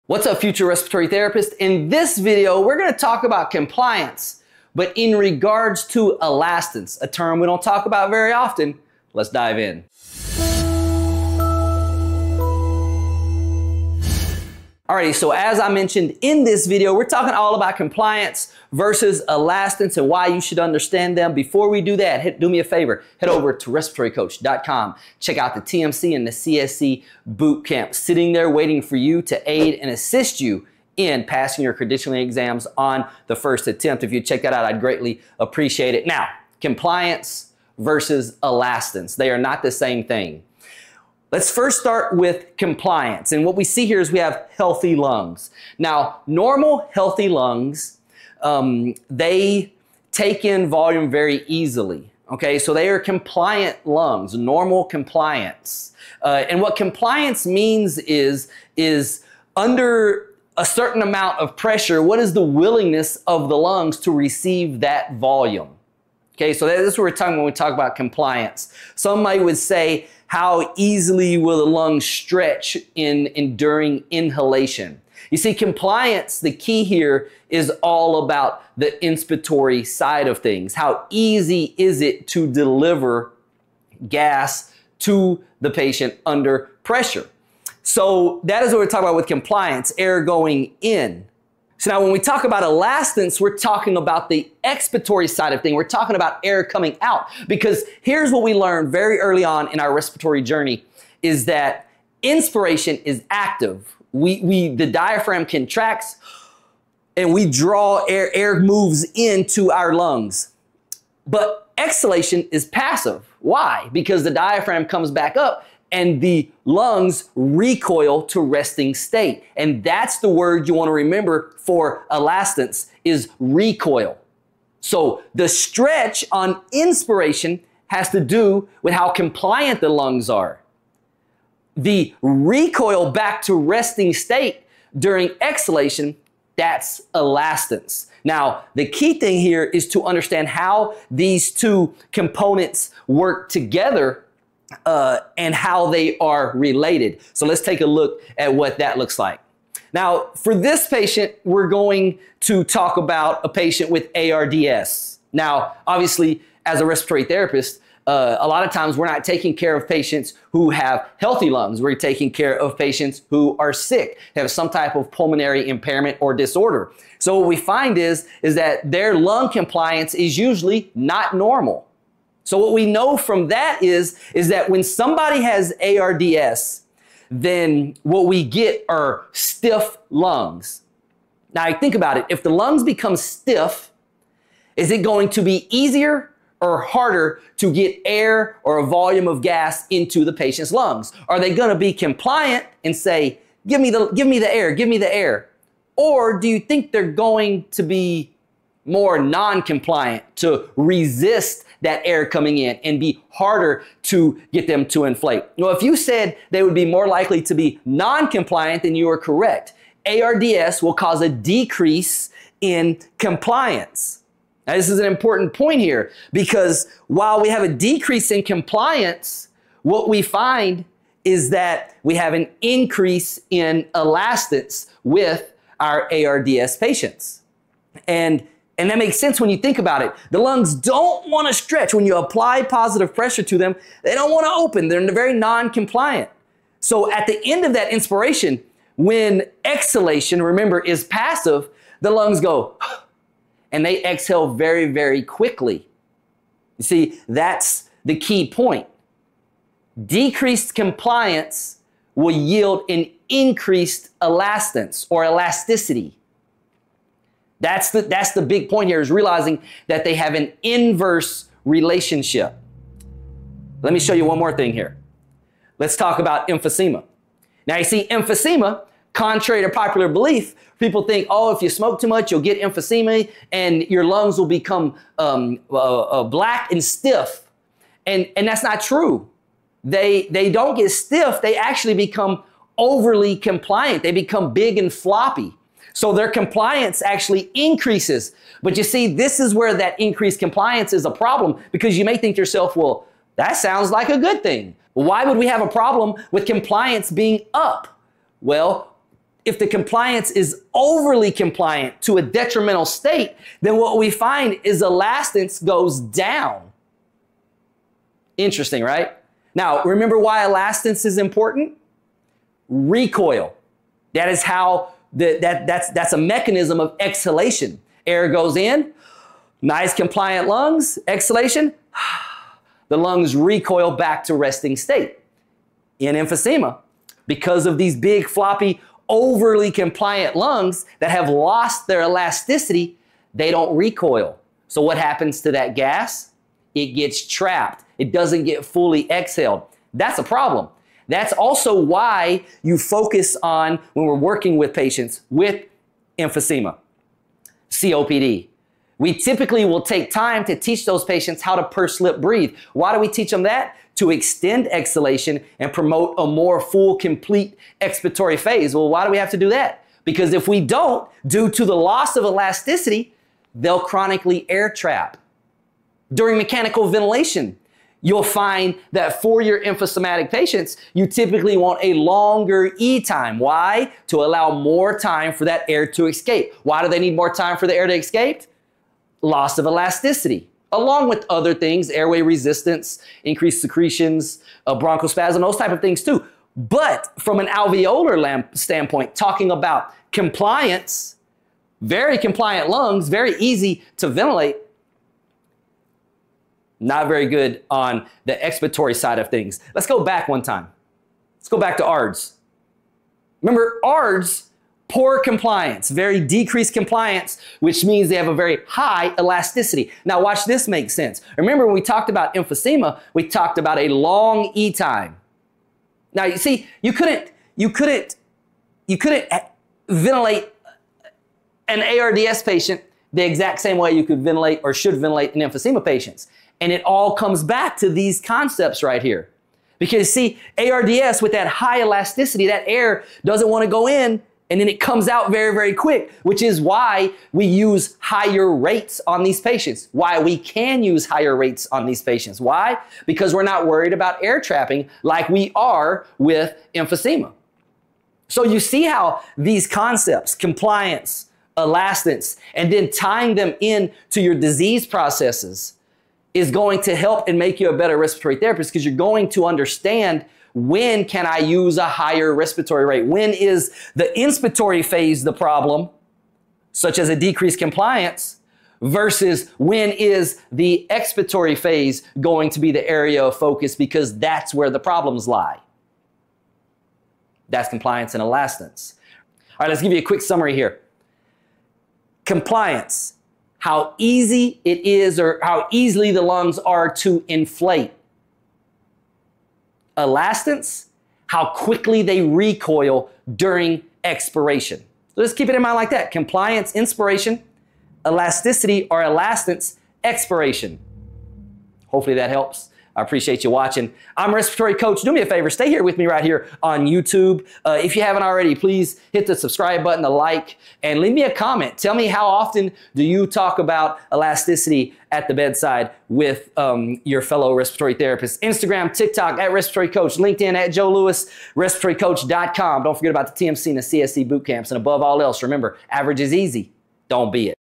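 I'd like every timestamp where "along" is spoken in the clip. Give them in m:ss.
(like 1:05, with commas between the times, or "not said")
6:20.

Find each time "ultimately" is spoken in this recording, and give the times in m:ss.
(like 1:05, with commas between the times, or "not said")
not said.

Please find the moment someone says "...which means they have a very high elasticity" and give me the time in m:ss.
6:47.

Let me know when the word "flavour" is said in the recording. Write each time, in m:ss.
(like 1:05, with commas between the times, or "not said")
not said.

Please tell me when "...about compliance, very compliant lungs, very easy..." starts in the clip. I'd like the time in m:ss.
6:29.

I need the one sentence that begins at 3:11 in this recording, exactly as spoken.
Are they going to be compliant and say, give me the, give me the air, give me the air?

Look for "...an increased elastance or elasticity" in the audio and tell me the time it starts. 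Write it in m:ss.
4:12.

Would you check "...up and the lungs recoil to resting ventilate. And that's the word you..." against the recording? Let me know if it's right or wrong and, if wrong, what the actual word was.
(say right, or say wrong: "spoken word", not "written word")
wrong: "state", not "ventilate".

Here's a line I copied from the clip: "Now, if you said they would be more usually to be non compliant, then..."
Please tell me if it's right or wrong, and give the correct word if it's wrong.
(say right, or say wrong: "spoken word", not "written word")
wrong: "likely", not "usually".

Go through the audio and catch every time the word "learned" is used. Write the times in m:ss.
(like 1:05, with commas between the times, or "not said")
1:38.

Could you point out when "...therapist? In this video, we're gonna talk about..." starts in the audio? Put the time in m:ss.
0:01.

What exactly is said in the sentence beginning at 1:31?
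So now when we talk about elastance, we're talking about the expiratory side of thing.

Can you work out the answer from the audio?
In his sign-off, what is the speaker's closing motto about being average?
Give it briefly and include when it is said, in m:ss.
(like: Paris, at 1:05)
Average is easy, at 8:45.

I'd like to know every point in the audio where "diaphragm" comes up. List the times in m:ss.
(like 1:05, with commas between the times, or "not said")
1:44, 1:54.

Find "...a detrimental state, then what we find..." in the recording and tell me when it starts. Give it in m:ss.
5:02.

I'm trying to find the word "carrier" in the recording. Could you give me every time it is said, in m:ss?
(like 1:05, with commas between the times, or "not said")
not said.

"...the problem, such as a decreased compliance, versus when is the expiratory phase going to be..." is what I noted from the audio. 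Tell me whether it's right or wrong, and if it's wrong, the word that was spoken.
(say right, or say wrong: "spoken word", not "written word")
right.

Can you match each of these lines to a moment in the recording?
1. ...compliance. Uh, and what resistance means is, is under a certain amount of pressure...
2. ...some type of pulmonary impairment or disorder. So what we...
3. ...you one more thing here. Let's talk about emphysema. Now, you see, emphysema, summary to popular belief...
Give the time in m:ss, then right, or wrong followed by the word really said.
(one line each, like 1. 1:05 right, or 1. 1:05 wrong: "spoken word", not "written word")
1. 0:54 wrong: "compliance", not "resistance"
2. 2:44 right
3. 4:24 wrong: "contrary", not "summary".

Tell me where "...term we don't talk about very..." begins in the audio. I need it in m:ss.
0:07.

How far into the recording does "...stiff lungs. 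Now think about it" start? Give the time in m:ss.
2:59.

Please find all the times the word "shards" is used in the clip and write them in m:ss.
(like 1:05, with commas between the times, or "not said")
not said.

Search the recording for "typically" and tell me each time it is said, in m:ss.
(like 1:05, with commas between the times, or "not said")
5:49, 6:11.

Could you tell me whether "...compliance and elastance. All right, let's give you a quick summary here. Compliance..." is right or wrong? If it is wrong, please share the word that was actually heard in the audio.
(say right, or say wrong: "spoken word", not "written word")
right.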